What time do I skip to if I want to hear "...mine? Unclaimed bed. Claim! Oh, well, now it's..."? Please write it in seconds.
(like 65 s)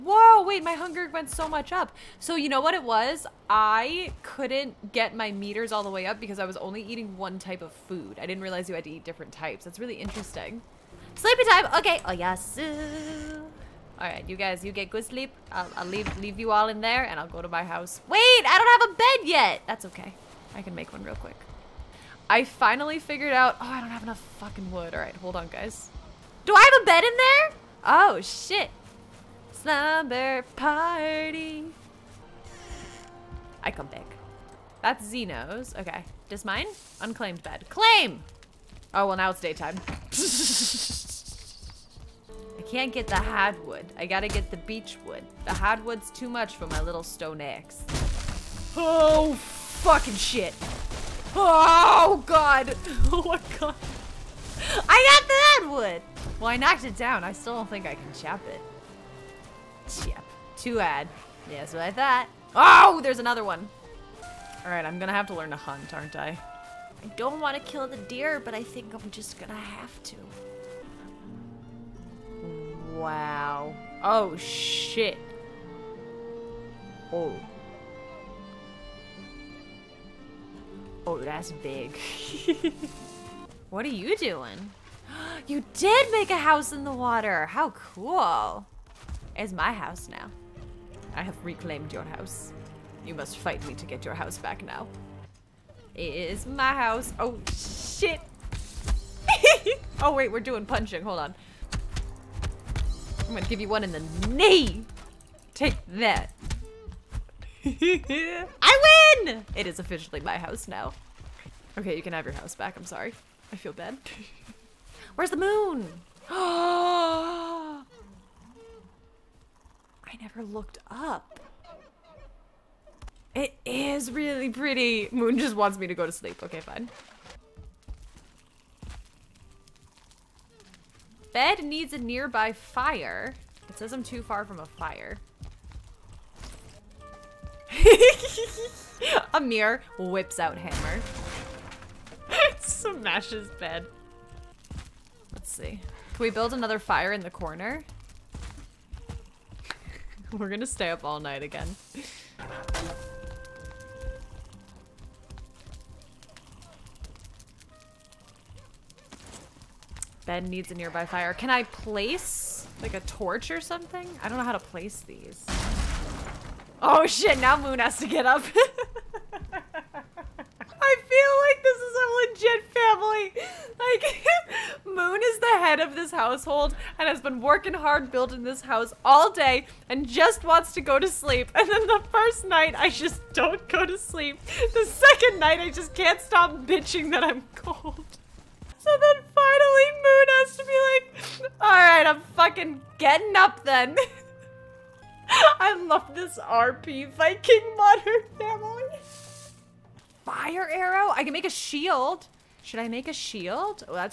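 36 s.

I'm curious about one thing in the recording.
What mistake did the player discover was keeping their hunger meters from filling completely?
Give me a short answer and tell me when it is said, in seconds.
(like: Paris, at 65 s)
Eating one type of food, at 6 s.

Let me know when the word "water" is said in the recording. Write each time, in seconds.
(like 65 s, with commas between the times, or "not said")
86 s.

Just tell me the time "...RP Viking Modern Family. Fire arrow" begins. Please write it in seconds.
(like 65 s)
196 s.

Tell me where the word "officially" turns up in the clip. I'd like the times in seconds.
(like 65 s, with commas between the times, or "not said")
109 s.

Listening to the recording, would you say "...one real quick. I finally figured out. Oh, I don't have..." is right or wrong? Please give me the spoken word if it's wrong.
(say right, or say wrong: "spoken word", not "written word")
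right.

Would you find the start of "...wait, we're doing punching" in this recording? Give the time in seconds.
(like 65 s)
100 s.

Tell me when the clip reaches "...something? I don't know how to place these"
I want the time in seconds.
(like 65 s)
163 s.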